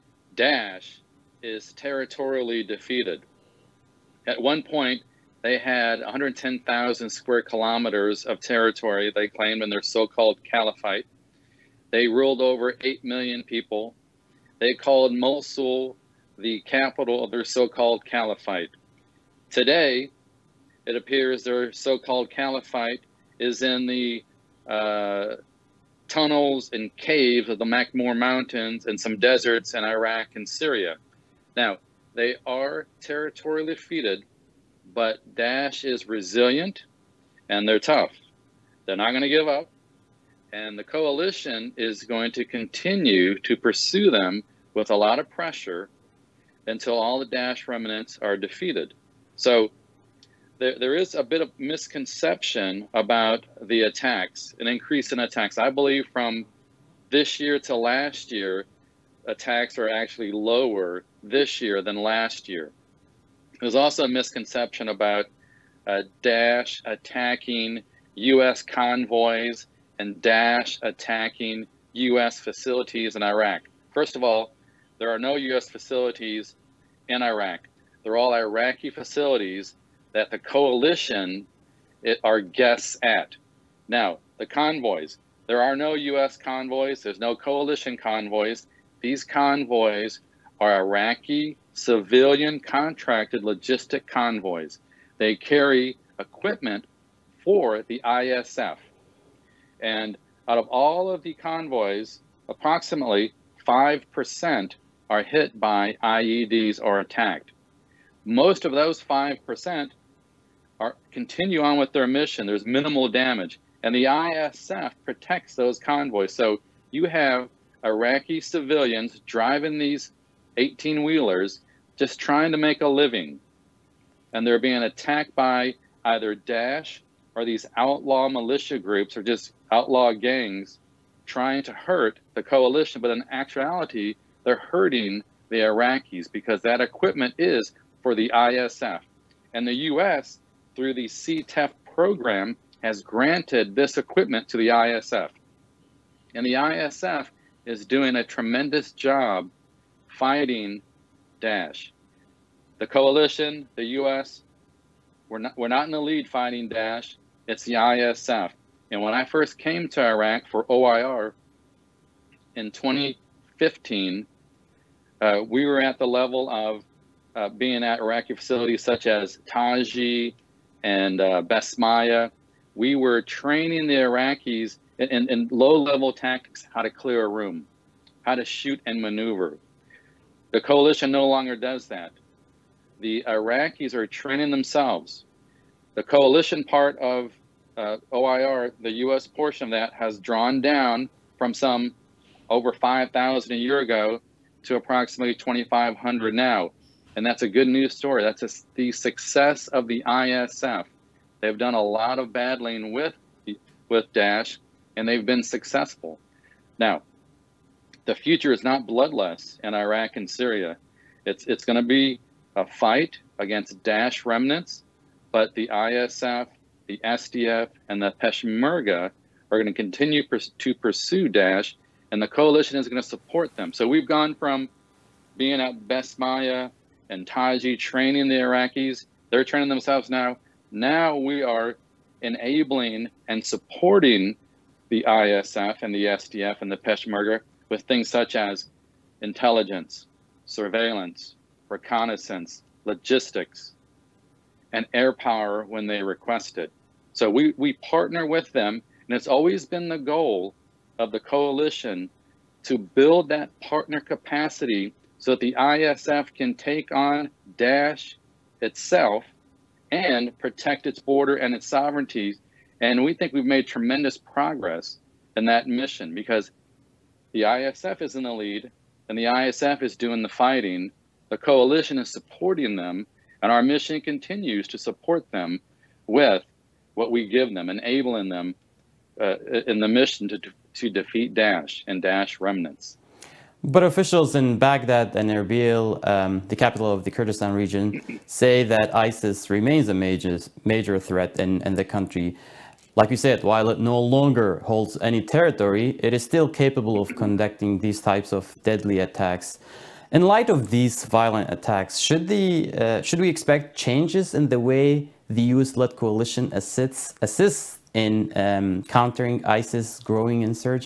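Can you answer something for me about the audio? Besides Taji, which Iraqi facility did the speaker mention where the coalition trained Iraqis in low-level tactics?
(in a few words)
Basmaya.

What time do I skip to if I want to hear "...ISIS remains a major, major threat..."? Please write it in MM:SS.
04:48.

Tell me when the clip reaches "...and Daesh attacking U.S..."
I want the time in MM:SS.
01:09.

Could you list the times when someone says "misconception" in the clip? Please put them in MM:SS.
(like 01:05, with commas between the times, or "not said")
00:51, 01:04.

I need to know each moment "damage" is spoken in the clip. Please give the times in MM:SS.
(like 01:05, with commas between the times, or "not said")
01:53.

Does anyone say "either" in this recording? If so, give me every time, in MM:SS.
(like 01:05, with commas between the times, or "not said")
02:06.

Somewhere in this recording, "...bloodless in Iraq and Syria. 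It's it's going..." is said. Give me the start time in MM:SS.
03:28.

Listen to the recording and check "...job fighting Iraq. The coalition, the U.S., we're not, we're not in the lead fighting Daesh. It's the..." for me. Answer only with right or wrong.
wrong.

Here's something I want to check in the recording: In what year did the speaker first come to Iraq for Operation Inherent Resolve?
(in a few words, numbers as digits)
2015.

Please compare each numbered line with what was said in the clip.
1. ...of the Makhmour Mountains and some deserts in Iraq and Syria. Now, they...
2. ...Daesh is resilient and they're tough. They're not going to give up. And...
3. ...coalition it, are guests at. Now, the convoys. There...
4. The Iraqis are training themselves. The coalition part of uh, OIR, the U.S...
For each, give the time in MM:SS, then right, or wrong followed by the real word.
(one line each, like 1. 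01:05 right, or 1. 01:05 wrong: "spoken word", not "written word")
1. 00:27 right
2. 00:35 right
3. 01:20 right
4. 03:03 right.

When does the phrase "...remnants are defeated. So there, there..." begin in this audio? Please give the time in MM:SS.
00:47.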